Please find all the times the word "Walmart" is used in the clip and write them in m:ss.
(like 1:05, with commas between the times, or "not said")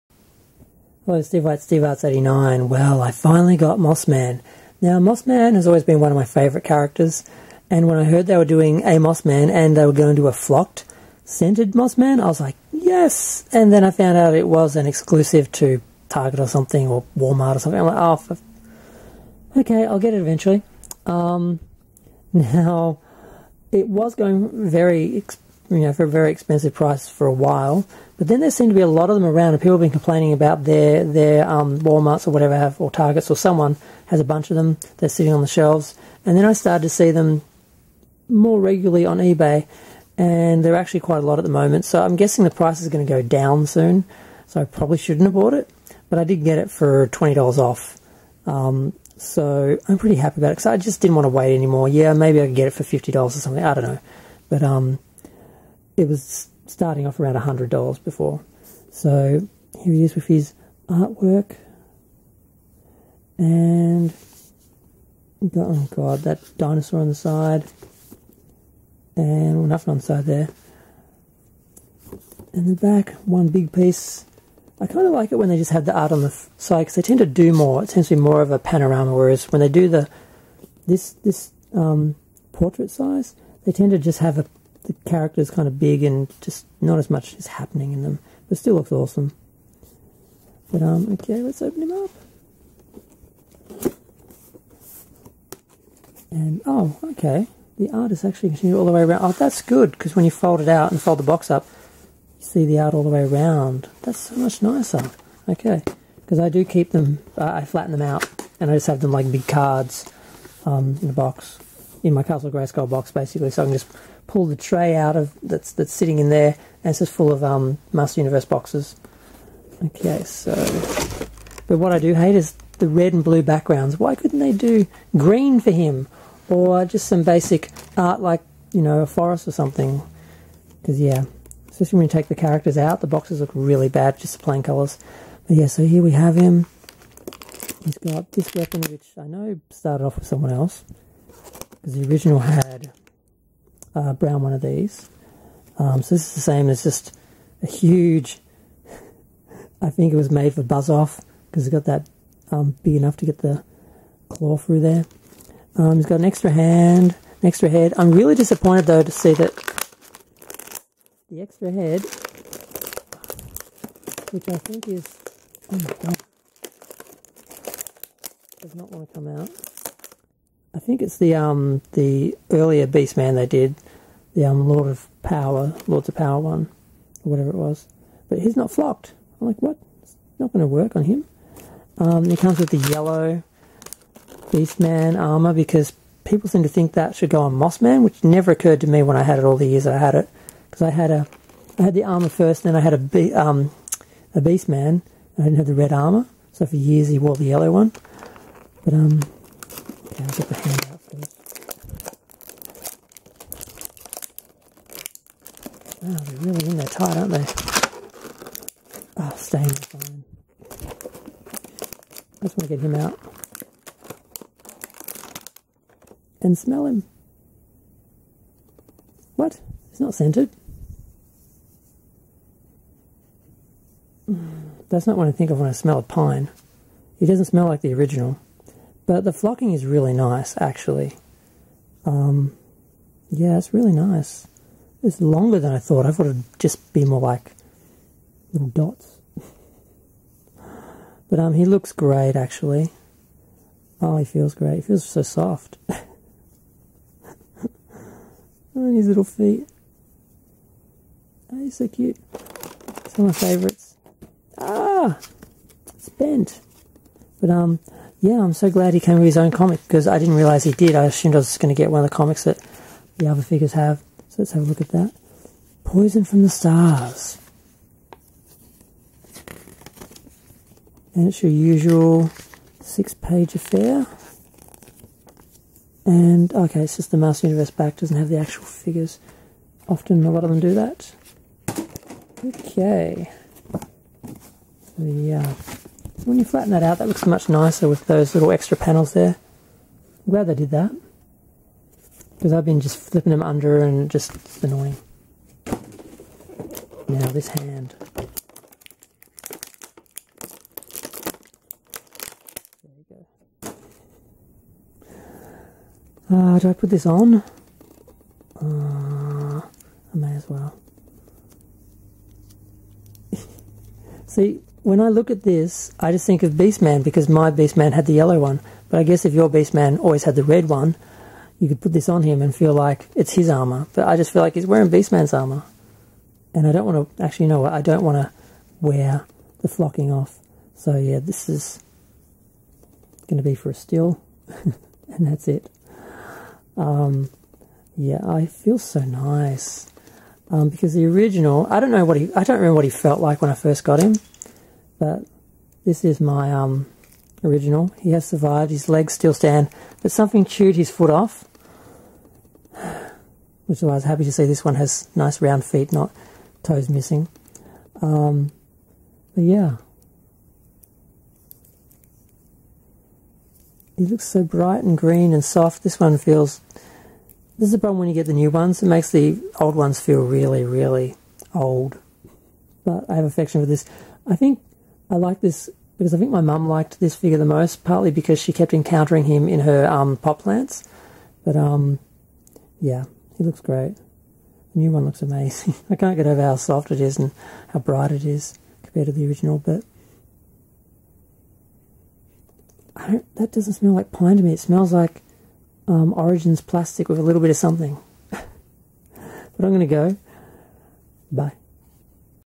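0:17, 0:31.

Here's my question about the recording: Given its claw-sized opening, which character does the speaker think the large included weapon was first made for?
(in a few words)
Buzz-Off.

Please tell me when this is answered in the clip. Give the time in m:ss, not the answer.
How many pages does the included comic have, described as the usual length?
4:32.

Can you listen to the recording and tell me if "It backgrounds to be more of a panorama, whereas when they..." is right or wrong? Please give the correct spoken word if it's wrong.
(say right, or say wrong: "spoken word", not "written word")
wrong: "tends", not "backgrounds".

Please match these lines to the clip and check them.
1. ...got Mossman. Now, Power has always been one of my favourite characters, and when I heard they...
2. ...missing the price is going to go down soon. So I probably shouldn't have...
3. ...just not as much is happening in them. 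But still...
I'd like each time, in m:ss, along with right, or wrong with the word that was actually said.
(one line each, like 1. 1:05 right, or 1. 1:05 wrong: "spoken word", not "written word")
1. 0:03 wrong: "Mossman", not "Power"
2. 0:42 wrong: "guessing", not "missing"
3. 1:26 right.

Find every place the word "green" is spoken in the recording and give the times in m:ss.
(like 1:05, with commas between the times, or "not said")
2:05, 6:04.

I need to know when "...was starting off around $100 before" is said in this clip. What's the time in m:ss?
0:56.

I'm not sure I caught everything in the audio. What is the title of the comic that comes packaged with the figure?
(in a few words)
Poison from the Stars.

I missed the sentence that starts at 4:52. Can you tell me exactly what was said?
Because I've been just flipping them under and just it's annoying.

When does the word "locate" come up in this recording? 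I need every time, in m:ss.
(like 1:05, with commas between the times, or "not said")
not said.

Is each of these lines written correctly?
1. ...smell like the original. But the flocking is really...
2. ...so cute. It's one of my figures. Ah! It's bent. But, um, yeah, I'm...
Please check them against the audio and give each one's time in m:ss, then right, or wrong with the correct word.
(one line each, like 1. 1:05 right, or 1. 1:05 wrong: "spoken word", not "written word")
1. 3:47 right
2. 4:11 wrong: "favourites", not "figures".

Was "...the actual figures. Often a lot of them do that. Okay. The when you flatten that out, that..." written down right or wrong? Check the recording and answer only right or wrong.
right.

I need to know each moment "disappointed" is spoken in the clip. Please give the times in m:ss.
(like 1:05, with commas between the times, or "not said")
2:38.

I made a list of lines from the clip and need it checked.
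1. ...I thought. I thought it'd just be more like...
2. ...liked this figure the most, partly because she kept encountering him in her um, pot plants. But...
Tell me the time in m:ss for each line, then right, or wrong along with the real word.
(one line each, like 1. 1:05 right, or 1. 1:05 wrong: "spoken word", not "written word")
1. 3:55 right
2. 6:16 right.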